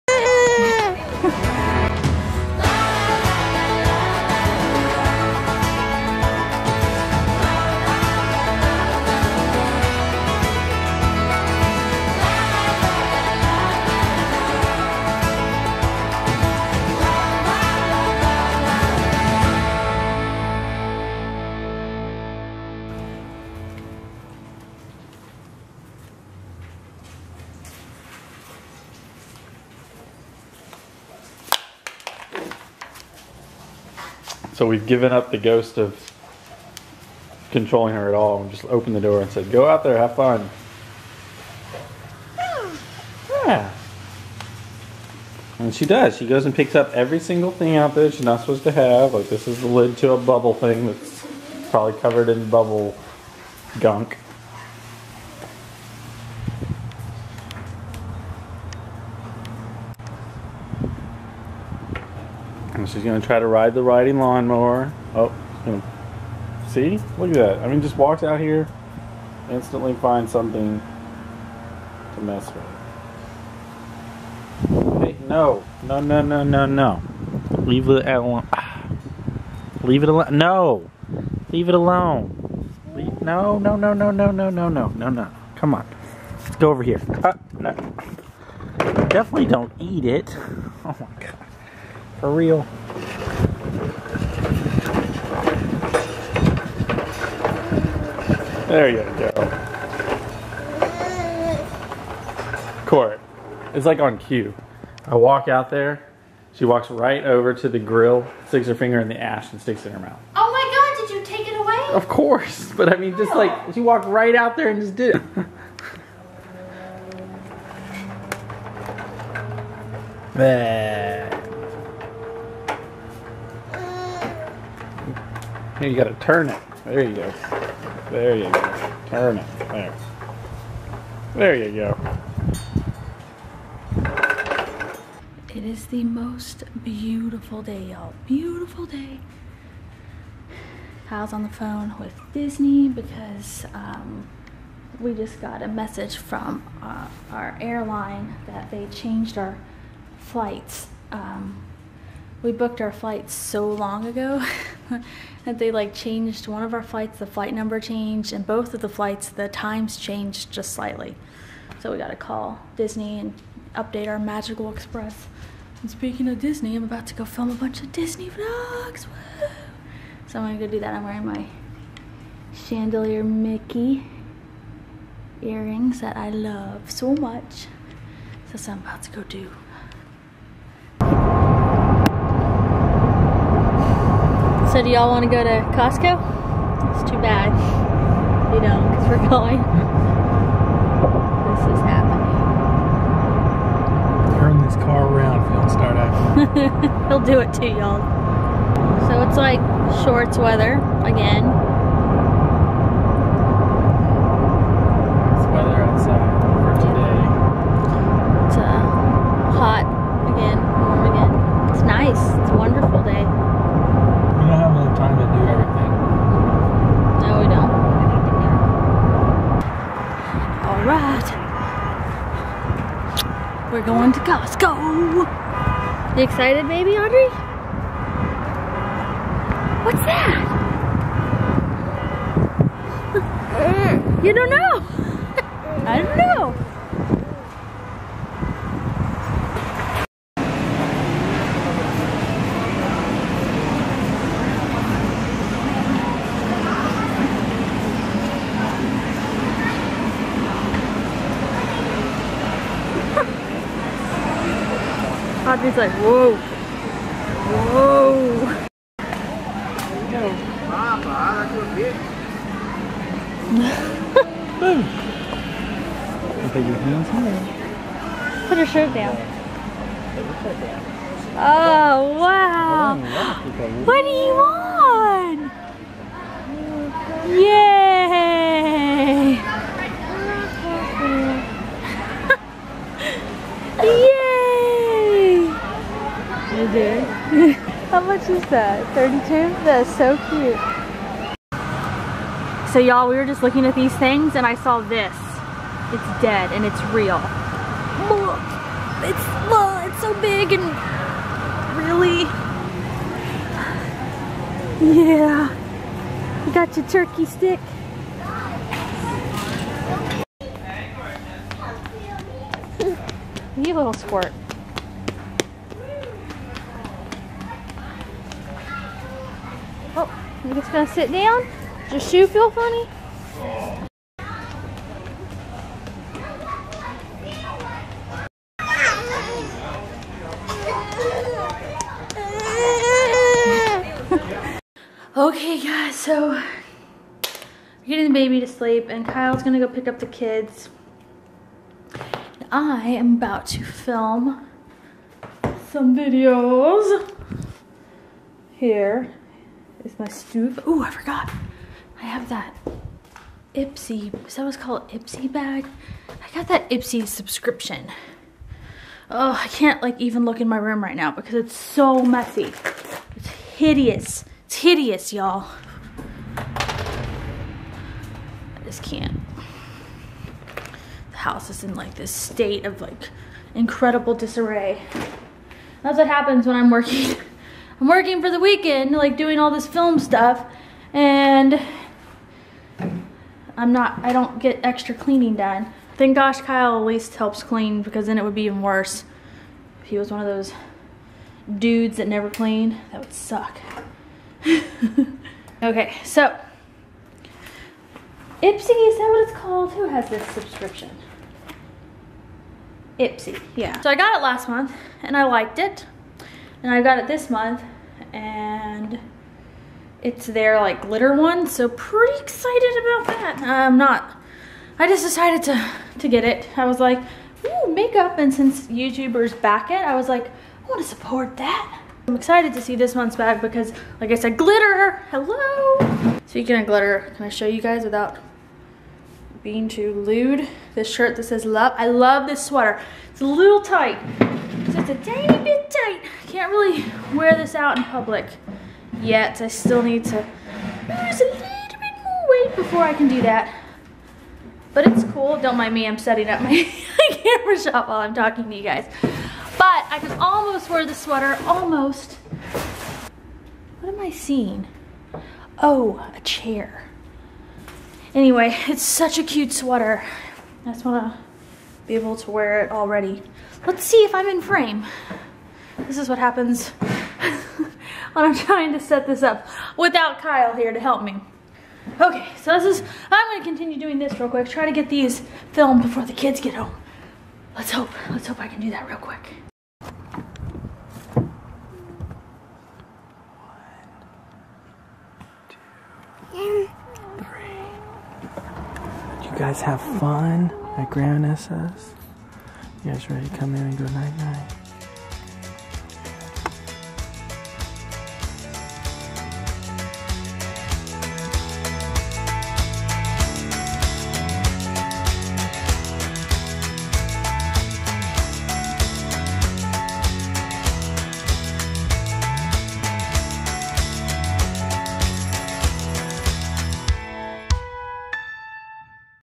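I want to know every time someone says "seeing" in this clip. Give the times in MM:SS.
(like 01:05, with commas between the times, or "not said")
07:34.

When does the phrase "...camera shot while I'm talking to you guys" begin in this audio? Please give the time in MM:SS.
07:27.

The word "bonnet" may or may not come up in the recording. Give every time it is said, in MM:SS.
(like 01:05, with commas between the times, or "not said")
not said.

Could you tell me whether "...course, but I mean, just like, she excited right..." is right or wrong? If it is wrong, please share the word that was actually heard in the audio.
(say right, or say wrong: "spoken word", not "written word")
wrong: "walked", not "excited".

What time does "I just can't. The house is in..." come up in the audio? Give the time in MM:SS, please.
06:06.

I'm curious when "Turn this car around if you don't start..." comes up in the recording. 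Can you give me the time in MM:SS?
03:14.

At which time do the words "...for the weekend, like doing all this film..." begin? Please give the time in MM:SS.
06:18.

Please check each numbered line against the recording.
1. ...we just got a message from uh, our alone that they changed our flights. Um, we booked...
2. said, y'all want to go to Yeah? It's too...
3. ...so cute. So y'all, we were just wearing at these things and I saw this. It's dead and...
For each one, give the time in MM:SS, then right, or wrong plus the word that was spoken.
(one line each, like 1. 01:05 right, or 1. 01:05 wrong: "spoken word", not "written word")
1. 02:24 wrong: "airline", not "alone"
2. 03:04 wrong: "Costco", not "Yeah"
3. 04:49 wrong: "looking", not "wearing".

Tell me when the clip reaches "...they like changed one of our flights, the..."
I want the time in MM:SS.
02:35.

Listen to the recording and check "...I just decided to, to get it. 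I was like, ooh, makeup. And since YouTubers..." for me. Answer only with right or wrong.
right.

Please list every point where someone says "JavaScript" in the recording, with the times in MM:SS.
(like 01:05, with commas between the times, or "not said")
not said.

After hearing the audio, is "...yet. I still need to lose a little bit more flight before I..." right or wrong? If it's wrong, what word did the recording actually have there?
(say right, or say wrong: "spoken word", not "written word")
wrong: "weight", not "flight".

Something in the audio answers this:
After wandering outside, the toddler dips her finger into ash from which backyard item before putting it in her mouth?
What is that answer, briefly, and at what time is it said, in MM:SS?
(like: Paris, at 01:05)
grill, at 01:47.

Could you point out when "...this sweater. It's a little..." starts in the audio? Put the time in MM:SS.
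07:12.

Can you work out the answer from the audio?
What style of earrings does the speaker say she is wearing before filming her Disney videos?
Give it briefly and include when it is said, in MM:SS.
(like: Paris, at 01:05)
chandelier Mickey earrings, at 02:52.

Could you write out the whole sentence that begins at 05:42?
I am about to film some videos here is my stove.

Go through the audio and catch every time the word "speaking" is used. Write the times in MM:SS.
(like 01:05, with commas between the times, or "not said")
02:45, 07:06.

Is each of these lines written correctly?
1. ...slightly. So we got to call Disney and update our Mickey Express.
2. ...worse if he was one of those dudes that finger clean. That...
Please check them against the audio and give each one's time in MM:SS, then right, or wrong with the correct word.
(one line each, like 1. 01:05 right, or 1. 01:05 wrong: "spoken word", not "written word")
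1. 02:40 wrong: "Magical", not "Mickey"
2. 06:28 wrong: "never", not "finger".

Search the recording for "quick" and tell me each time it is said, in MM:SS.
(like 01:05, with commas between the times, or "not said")
07:54, 07:58.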